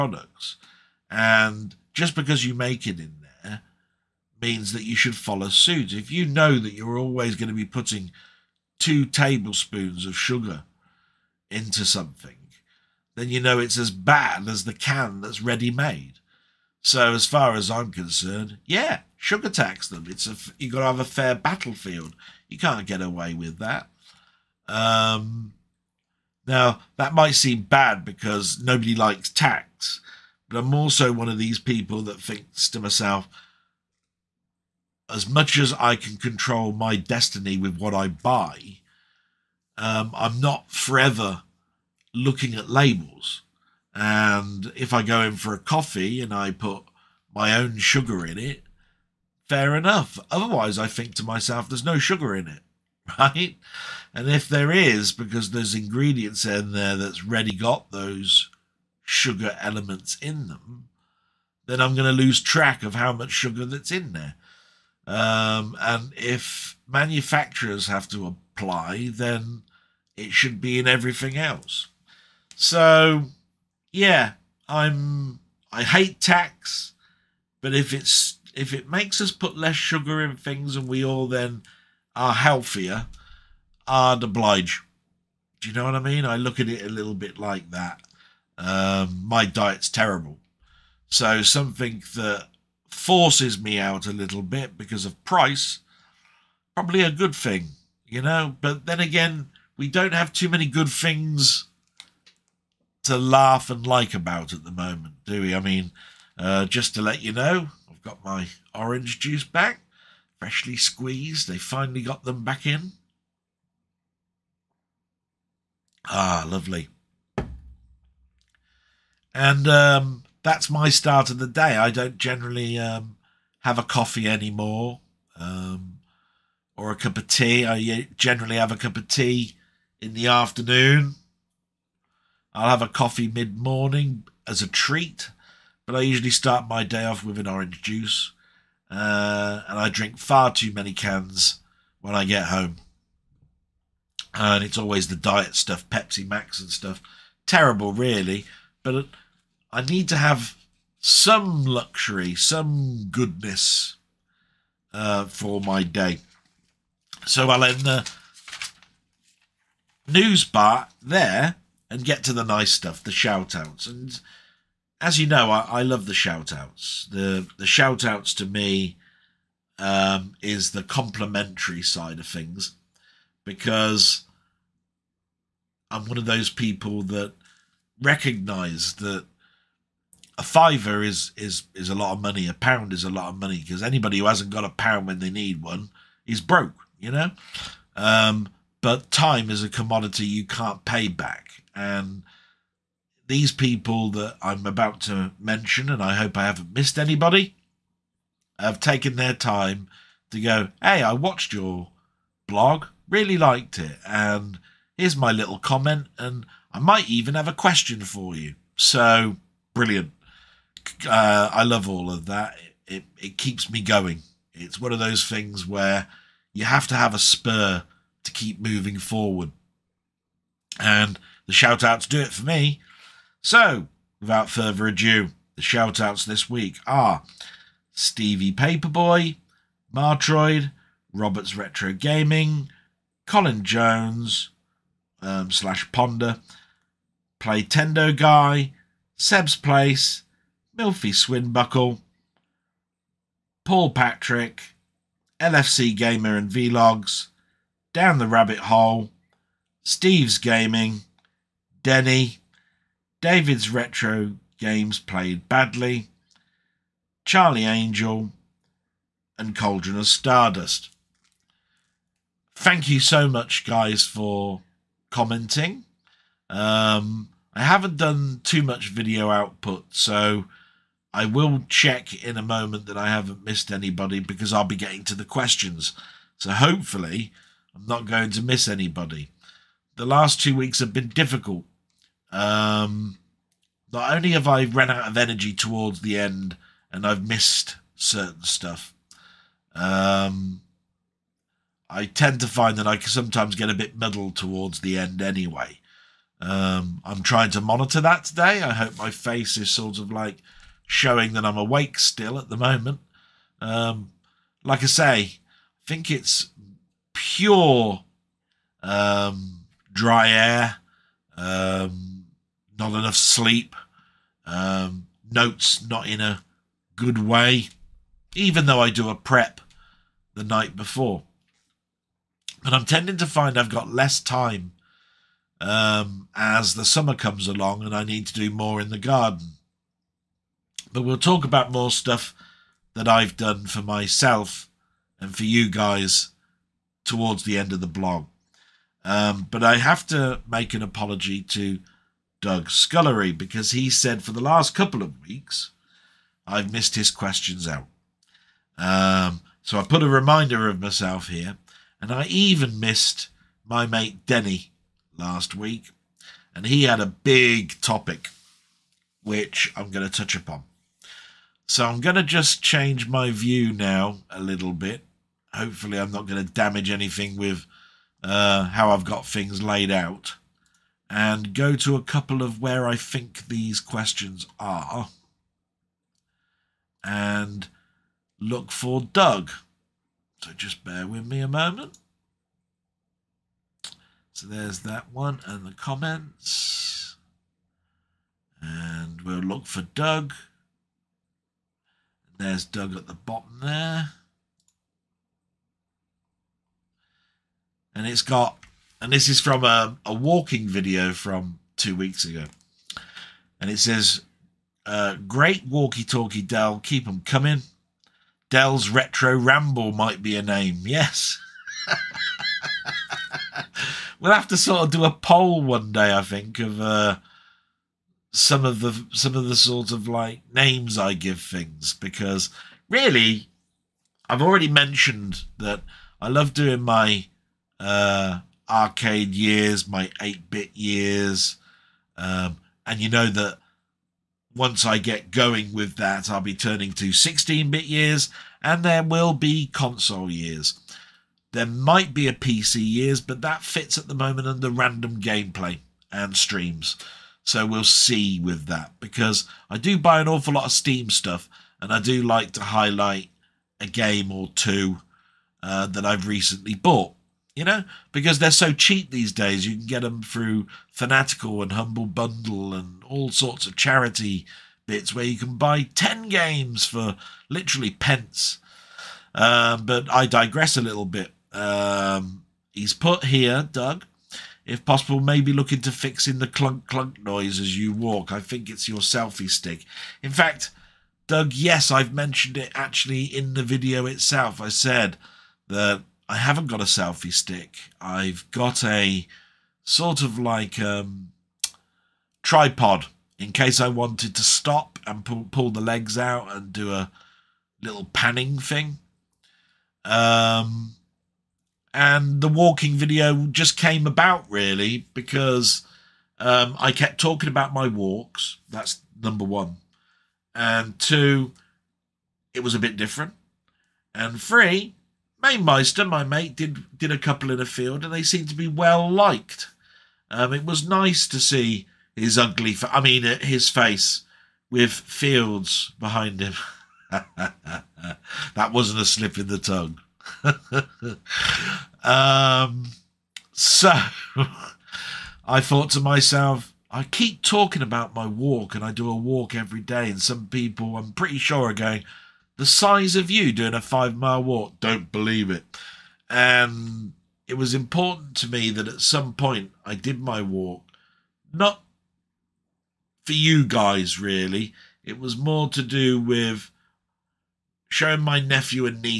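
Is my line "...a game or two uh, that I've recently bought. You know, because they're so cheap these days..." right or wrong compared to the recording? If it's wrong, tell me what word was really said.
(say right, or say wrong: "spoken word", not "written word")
right.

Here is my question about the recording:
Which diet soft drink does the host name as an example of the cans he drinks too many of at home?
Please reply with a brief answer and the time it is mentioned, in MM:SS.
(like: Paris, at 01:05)
Pepsi Max, at 02:25.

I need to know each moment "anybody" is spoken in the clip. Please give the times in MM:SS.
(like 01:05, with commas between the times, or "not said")
03:03, 03:16, 04:33, 04:38.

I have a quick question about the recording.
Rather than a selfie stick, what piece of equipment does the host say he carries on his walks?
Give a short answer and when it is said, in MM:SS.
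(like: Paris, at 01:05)
tripod, at 08:12.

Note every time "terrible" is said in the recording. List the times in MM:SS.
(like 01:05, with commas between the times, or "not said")
01:29, 02:27.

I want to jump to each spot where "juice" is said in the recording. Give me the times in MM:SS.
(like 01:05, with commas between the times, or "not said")
01:49, 02:17.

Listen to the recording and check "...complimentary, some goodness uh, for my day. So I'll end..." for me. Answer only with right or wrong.
wrong.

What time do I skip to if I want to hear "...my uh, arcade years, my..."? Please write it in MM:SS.
07:06.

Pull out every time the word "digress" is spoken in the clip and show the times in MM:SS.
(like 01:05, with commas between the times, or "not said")
07:50.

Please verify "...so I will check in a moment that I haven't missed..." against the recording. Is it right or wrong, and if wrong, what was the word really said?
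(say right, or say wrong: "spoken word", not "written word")
right.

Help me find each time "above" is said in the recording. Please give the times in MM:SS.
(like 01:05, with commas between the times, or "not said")
not said.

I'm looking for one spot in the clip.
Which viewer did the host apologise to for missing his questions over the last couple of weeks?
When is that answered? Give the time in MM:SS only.
05:42.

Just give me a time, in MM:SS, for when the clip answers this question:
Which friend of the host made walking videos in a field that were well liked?
08:35.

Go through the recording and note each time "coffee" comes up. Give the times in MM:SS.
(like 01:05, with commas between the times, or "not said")
00:45, 02:03, 02:12.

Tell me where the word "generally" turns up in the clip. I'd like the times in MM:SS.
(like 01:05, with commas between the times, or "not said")
02:02, 02:08.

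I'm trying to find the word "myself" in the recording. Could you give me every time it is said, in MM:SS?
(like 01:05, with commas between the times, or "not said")
00:32, 00:51, 05:33, 05:50, 08:55.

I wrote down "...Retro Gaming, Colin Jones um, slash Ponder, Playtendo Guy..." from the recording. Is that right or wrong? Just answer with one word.
right.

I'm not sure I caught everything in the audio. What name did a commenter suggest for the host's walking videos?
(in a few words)
Del's Retro Ramble.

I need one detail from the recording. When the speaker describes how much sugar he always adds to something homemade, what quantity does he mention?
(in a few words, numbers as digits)
2 tablespoons.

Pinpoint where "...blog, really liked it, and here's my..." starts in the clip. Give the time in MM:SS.
03:22.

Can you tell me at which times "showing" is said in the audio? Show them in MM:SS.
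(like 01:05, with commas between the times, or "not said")
05:00, 09:17.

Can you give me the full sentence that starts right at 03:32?
It, it, it keeps me going.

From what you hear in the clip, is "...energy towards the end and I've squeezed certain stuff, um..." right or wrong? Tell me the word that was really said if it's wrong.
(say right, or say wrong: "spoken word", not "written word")
wrong: "missed", not "squeezed".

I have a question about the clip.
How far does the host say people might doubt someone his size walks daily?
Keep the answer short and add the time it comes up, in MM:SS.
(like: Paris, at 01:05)
5 miles, at 09:03.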